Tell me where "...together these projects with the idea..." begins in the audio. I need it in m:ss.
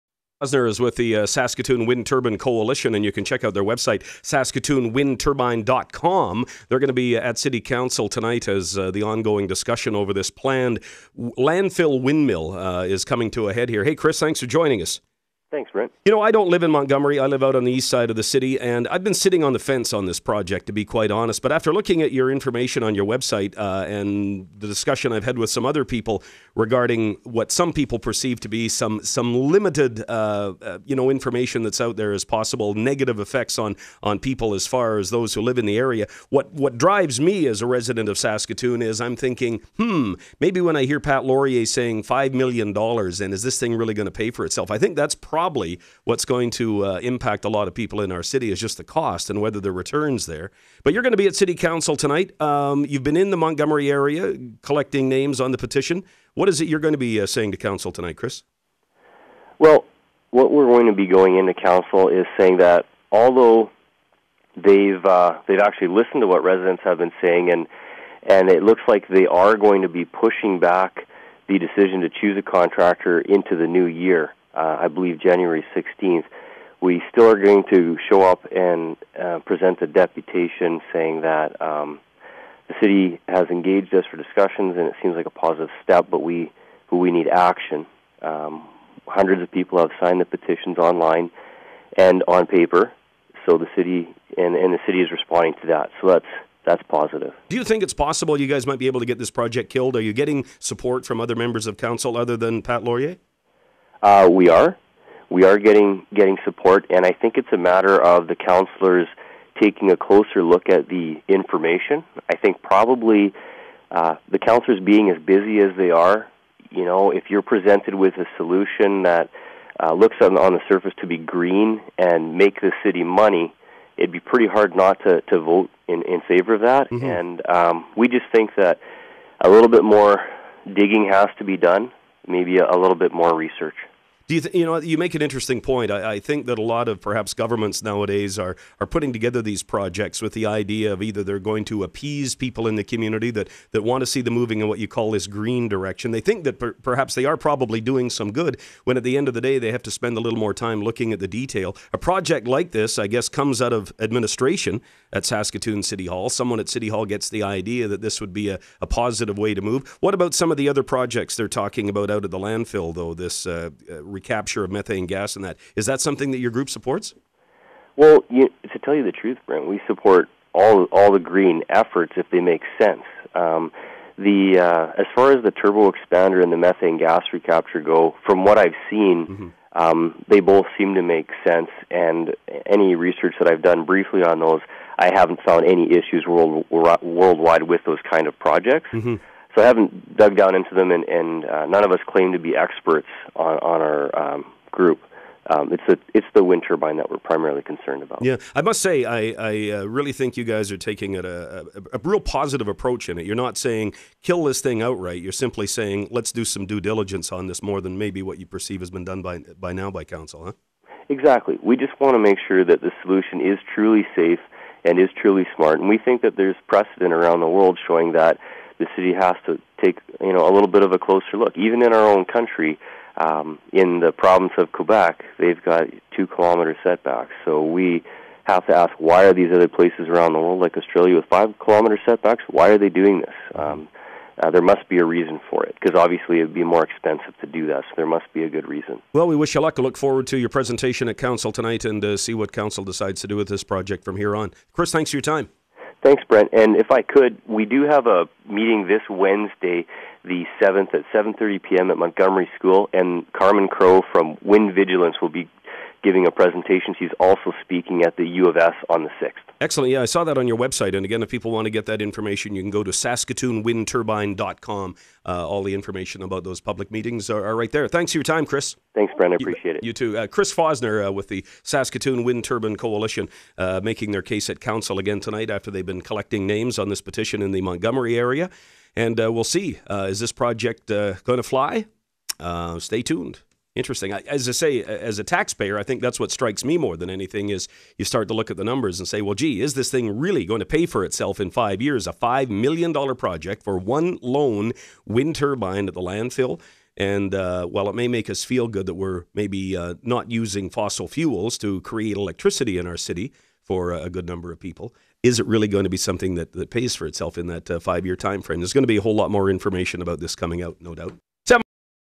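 2:19.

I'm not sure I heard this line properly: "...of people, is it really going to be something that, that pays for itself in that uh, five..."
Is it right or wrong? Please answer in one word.
right.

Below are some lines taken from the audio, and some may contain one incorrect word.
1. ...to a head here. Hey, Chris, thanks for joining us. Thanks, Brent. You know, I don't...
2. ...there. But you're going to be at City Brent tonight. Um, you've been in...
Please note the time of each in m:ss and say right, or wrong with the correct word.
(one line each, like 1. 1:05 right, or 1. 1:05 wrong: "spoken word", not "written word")
1. 0:13 right
2. 0:50 wrong: "Council", not "Brent".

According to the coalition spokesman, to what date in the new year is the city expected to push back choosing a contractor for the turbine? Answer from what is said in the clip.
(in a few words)
January 16th.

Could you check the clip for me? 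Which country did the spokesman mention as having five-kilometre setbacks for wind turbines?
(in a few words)
Australia.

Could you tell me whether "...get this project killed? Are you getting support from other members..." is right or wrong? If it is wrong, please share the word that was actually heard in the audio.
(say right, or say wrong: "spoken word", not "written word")
right.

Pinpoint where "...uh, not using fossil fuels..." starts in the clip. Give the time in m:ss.
4:59.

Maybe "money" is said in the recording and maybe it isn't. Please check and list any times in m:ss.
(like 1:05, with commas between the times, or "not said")
2:03.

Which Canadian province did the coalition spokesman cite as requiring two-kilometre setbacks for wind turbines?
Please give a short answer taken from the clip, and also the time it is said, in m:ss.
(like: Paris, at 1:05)
Quebec, at 3:44.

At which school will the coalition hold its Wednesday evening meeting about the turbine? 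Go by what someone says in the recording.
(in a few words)
Montgomery School.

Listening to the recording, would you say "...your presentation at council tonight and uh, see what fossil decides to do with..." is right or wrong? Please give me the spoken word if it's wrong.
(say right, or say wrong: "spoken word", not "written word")
wrong: "council", not "fossil".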